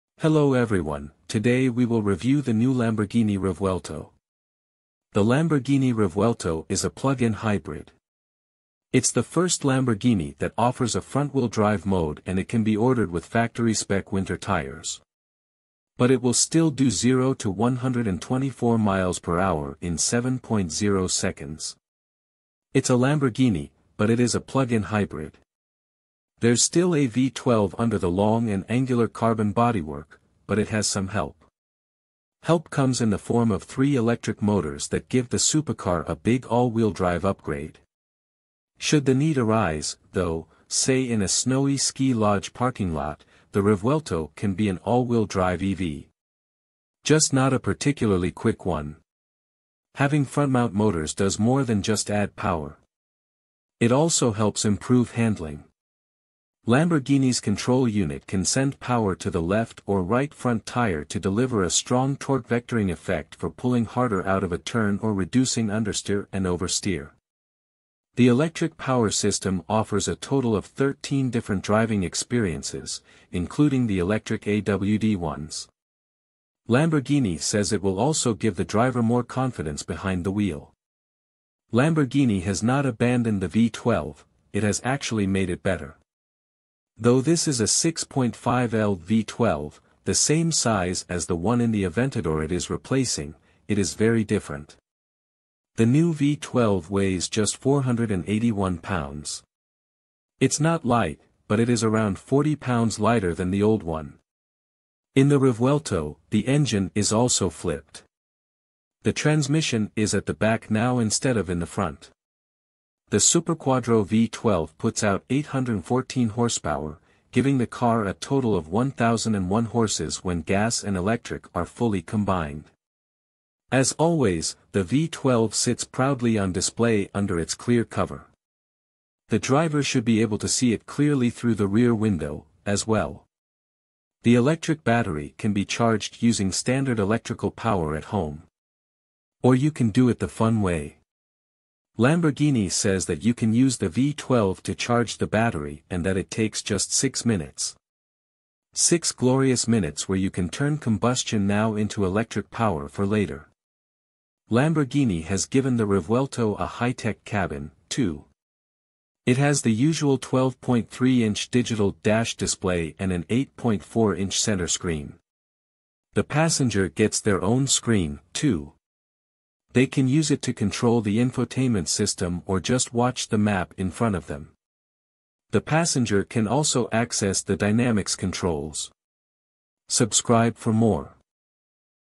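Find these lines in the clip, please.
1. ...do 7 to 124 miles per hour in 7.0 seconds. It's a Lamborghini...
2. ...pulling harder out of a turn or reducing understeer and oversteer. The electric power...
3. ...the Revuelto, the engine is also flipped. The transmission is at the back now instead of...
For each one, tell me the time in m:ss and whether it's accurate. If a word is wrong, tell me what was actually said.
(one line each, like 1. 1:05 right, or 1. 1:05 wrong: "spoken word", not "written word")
1. 0:16 wrong: "0", not "7"
2. 1:03 right
3. 1:45 right.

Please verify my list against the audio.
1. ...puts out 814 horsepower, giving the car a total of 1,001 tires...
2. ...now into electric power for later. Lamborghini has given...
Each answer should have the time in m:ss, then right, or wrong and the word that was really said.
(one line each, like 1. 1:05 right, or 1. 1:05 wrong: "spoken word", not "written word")
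1. 1:54 wrong: "horses", not "tires"
2. 2:31 right.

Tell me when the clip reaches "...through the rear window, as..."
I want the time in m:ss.
2:11.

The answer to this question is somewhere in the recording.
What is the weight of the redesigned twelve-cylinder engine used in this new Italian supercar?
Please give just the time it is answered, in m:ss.
1:37.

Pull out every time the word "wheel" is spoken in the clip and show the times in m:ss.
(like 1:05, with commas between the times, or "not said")
0:11, 0:36, 0:44, 1:20.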